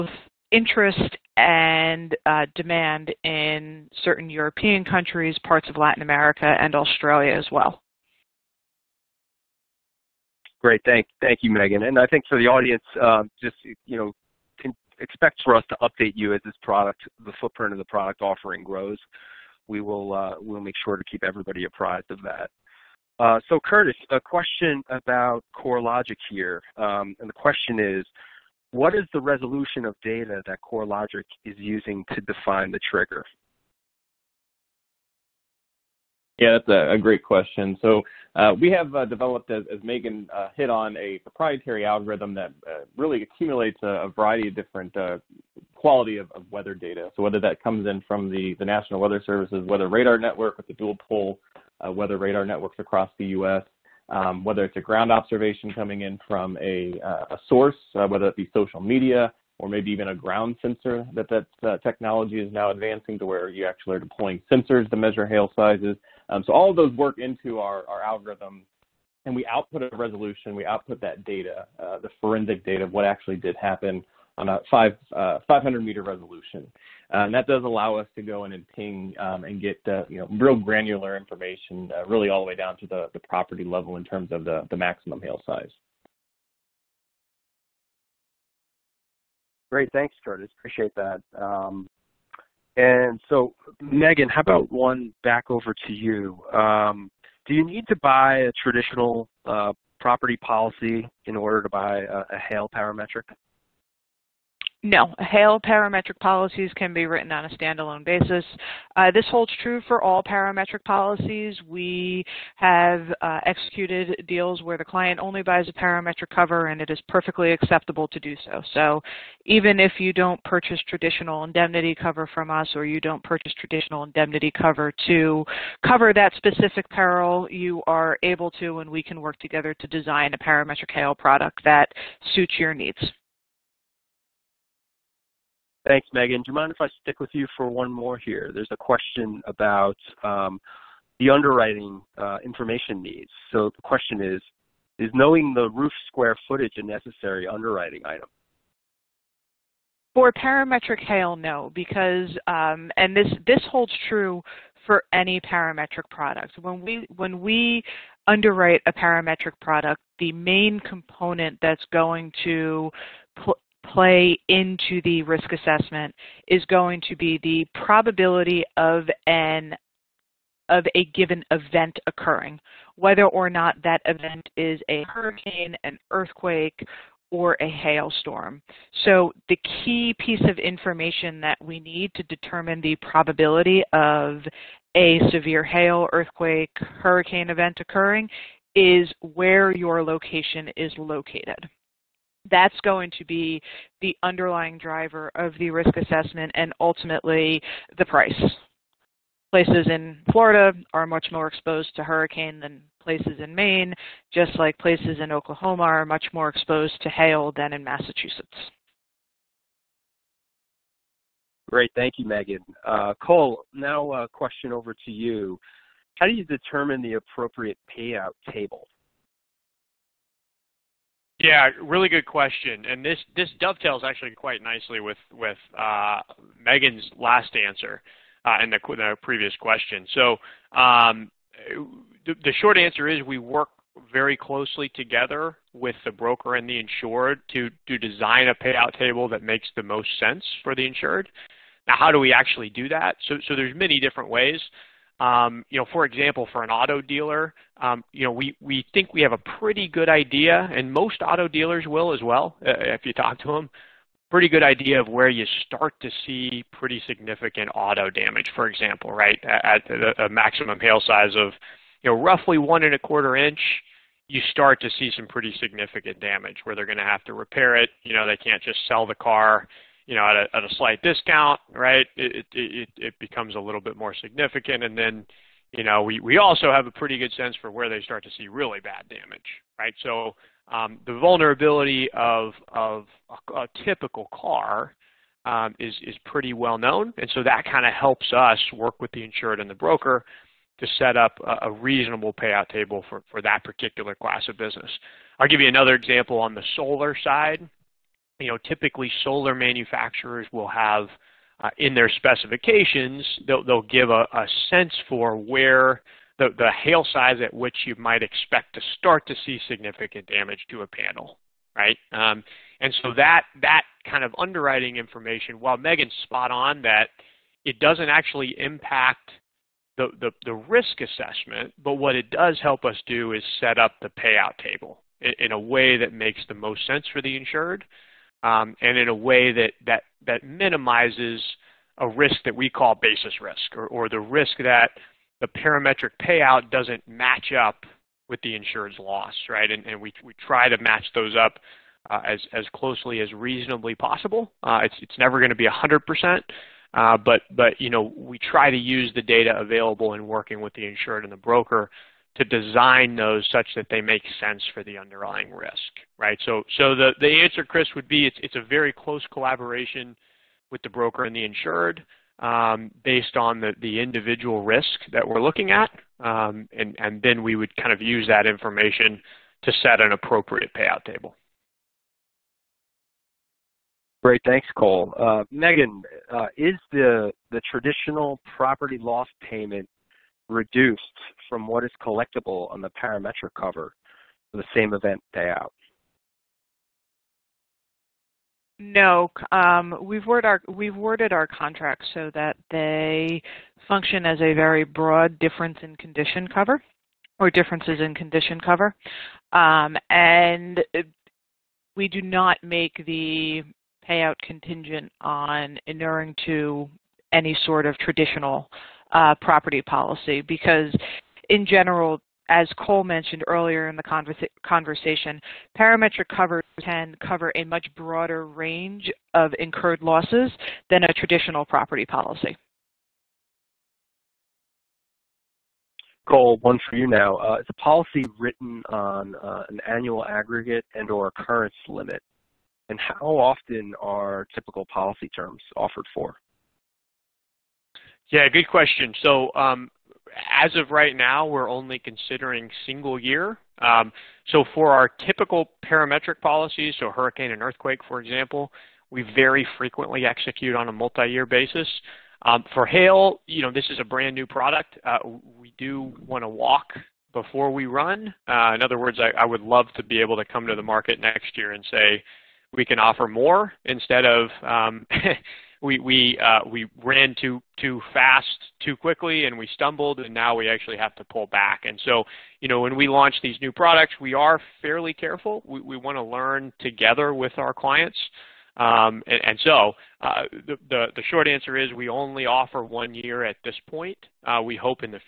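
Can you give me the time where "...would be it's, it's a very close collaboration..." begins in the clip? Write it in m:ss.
5:57.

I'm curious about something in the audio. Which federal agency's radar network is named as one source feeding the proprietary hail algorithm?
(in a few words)
National Weather Service.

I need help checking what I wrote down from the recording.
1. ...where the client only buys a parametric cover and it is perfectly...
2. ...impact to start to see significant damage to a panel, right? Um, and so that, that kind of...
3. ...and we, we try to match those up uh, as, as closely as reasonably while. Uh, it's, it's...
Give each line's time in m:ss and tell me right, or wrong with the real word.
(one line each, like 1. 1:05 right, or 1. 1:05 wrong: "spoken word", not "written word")
1. 1:54 right
2. 5:08 wrong: "expect", not "impact"
3. 5:39 wrong: "possible", not "while".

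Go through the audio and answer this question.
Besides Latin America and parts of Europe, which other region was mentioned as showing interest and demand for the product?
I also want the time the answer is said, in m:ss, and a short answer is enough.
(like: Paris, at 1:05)
Australia, at 0:06.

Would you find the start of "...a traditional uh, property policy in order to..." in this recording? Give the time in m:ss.
1:38.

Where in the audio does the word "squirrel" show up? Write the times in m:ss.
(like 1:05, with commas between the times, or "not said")
not said.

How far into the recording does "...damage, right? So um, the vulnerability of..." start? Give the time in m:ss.
4:39.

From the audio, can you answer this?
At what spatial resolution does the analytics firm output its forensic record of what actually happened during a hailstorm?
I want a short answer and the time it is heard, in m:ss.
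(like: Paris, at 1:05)
500 meters, at 1:15.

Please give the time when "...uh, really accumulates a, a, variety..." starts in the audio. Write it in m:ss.
0:42.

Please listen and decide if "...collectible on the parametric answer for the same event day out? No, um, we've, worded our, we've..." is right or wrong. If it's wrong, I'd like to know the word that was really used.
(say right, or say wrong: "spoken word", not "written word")
wrong: "cover", not "answer".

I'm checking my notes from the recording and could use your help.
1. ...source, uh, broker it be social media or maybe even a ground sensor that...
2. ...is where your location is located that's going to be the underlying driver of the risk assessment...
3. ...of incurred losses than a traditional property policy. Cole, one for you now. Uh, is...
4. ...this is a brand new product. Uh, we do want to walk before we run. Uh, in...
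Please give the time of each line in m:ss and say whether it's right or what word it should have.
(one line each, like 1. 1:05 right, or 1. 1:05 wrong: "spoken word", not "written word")
1. 0:57 wrong: "whether", not "broker"
2. 3:08 right
3. 6:59 right
4. 7:33 right.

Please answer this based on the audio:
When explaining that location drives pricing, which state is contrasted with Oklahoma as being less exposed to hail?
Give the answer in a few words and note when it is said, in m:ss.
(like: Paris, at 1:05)
Massachusetts, at 3:27.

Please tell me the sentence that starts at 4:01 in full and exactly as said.
Now, how do we actually do that?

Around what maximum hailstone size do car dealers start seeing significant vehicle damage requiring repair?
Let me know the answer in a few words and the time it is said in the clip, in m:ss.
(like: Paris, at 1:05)
1.25 inches, at 4:22.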